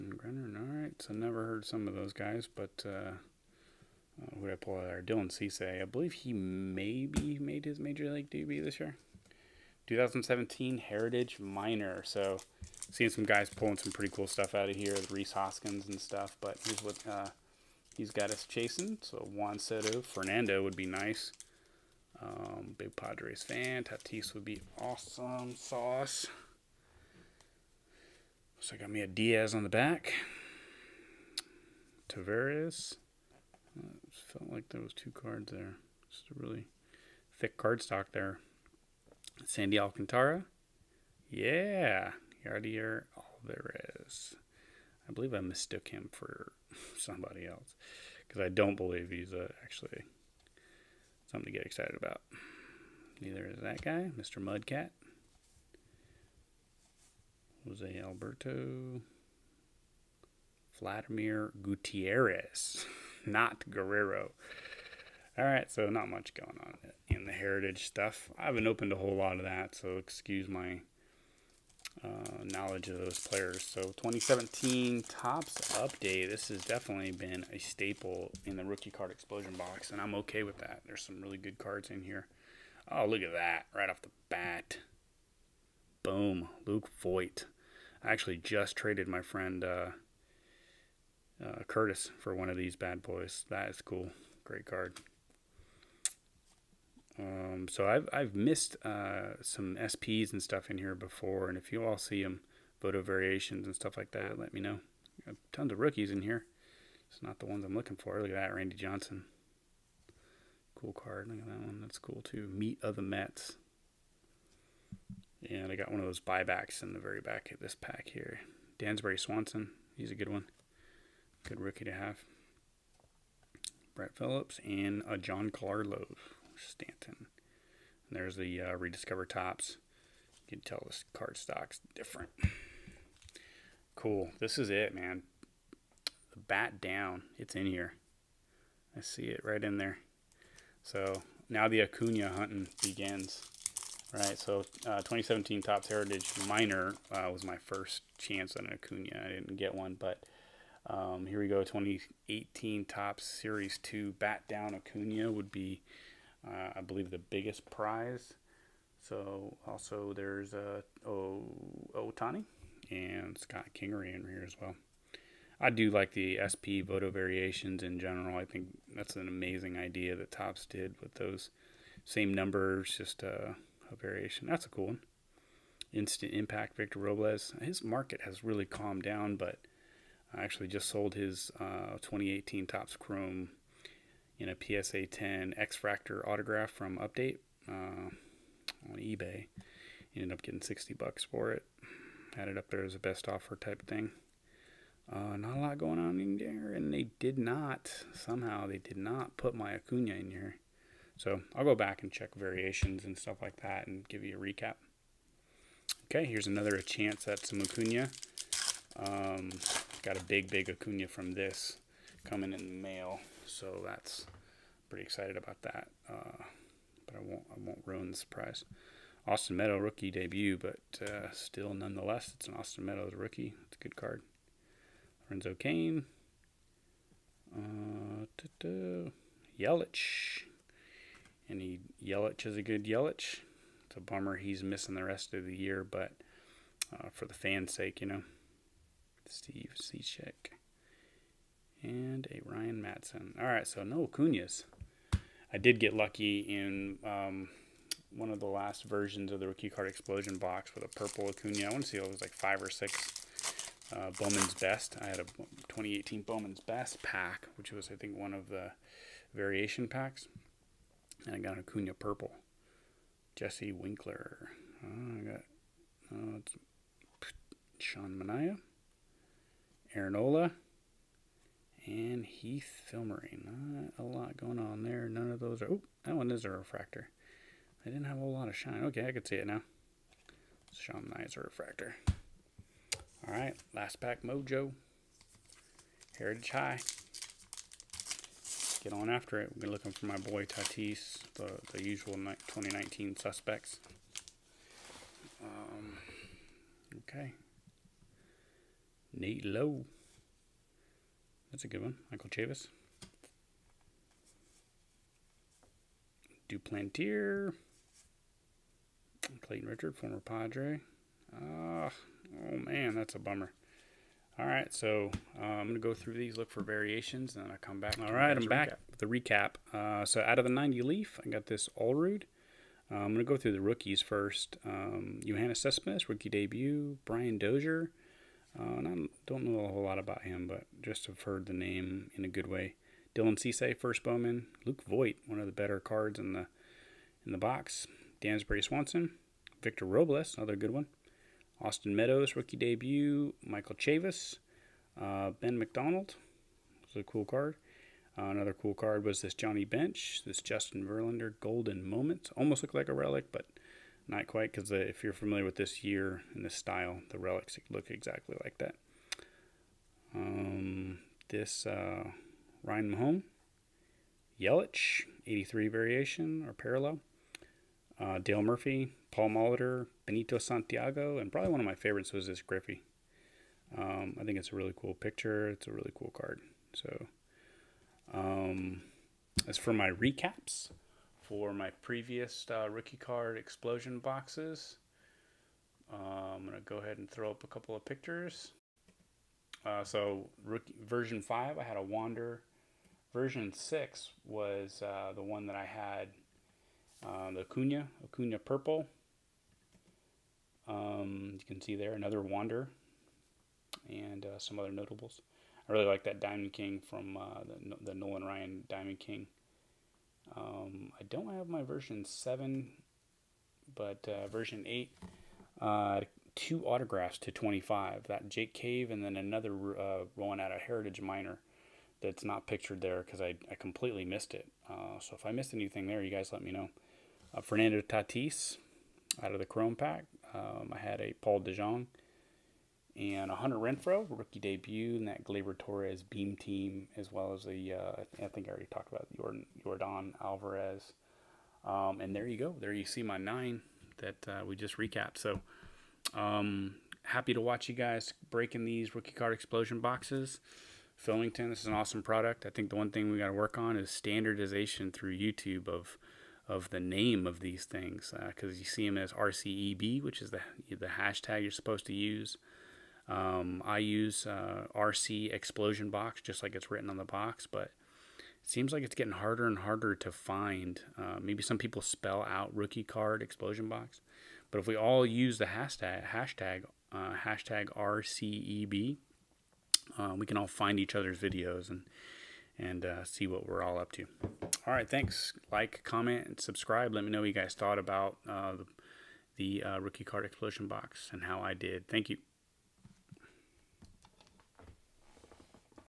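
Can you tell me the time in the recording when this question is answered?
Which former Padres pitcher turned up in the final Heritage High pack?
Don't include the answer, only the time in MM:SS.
05:09.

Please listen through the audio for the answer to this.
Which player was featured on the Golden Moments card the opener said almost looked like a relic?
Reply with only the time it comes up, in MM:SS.
05:50.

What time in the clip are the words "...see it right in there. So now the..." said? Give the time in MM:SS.
02:19.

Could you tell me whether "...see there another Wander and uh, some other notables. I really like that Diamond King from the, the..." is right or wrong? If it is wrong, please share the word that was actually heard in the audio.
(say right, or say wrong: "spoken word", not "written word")
right.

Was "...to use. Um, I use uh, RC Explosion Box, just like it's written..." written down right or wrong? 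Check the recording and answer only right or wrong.
right.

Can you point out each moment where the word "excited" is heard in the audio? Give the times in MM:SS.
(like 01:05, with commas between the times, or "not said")
00:51, 03:35.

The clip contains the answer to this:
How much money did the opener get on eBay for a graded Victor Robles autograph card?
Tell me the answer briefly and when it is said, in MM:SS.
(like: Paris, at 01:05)
$60, at 03:10.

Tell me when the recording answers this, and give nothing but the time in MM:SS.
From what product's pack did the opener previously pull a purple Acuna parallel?
04:15.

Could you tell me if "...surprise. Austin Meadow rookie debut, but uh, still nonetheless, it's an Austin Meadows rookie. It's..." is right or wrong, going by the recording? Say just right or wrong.
right.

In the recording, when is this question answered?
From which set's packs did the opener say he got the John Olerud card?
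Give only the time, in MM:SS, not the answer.
05:20.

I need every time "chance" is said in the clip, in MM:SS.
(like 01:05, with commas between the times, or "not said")
02:28, 03:26.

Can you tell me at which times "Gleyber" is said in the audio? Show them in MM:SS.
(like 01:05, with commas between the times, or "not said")
07:15.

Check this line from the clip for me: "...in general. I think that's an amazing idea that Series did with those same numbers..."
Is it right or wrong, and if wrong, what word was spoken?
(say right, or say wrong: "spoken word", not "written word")
wrong: "Topps", not "Series".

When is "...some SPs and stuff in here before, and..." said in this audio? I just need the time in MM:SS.
01:39.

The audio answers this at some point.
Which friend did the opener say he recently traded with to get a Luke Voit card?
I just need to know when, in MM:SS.
01:31.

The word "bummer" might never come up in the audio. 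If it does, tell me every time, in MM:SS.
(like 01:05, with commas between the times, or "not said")
03:53, 05:13.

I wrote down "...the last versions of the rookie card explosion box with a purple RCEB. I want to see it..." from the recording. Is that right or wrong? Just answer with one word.
wrong.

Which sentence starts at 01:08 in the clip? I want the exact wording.
I haven't opened a whole lot of that, so excuse my uh, knowledge of those players.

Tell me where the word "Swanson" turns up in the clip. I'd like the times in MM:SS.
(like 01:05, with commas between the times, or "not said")
01:59, 05:38.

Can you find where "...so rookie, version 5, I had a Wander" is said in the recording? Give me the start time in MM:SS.
06:29.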